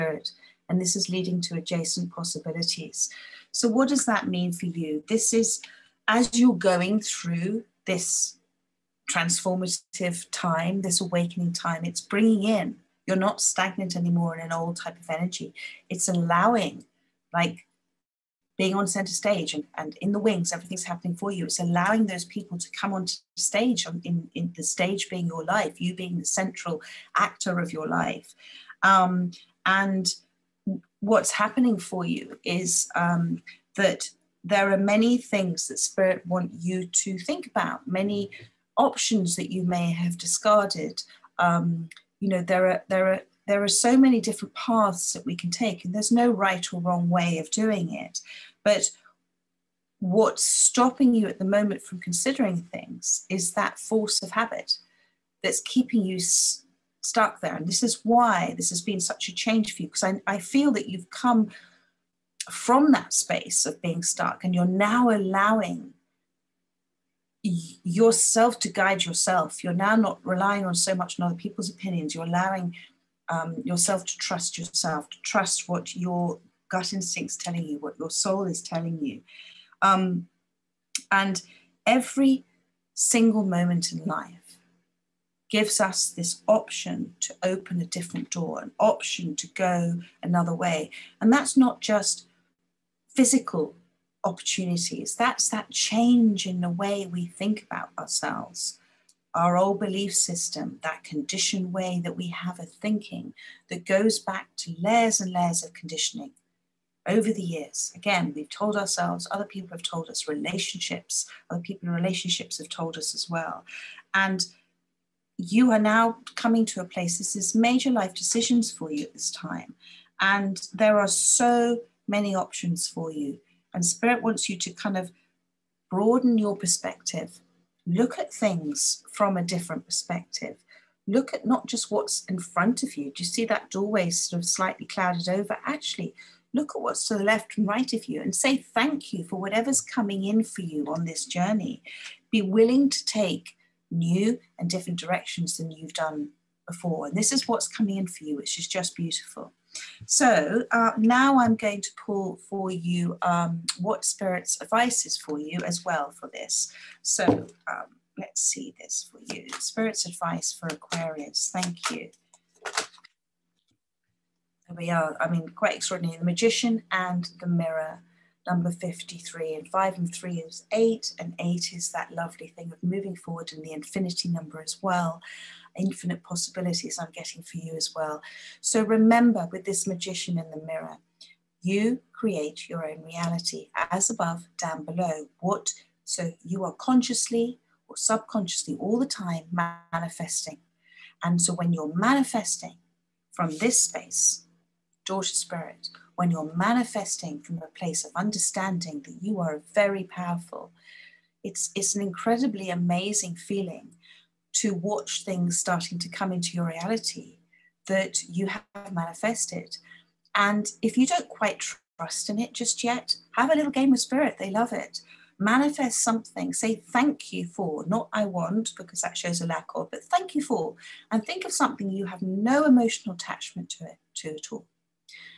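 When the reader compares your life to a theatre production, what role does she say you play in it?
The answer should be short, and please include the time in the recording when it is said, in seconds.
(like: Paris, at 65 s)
central actor, at 26 s.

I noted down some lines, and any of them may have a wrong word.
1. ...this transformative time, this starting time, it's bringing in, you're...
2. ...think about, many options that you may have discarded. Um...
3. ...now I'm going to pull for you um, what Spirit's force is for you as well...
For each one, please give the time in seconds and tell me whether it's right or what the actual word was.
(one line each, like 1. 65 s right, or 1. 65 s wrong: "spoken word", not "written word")
1. 7 s wrong: "awakening", not "starting"
2. 37 s right
3. 150 s wrong: "advice", not "force".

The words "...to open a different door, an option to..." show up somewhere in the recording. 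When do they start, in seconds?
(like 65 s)
87 s.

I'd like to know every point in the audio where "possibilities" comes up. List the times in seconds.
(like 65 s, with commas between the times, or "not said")
2 s, 176 s.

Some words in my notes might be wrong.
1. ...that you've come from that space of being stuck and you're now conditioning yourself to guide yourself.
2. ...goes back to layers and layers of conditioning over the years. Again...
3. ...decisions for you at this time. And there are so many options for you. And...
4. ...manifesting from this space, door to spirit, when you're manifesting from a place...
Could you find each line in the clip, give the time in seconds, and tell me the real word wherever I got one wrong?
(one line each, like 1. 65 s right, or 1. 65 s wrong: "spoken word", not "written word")
1. 60 s wrong: "allowing", not "conditioning"
2. 103 s right
3. 118 s right
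4. 191 s right.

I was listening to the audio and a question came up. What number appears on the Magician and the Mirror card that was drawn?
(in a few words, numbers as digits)
53.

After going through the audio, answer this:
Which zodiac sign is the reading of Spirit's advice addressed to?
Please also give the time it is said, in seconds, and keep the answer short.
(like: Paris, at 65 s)
Aquarius, at 160 s.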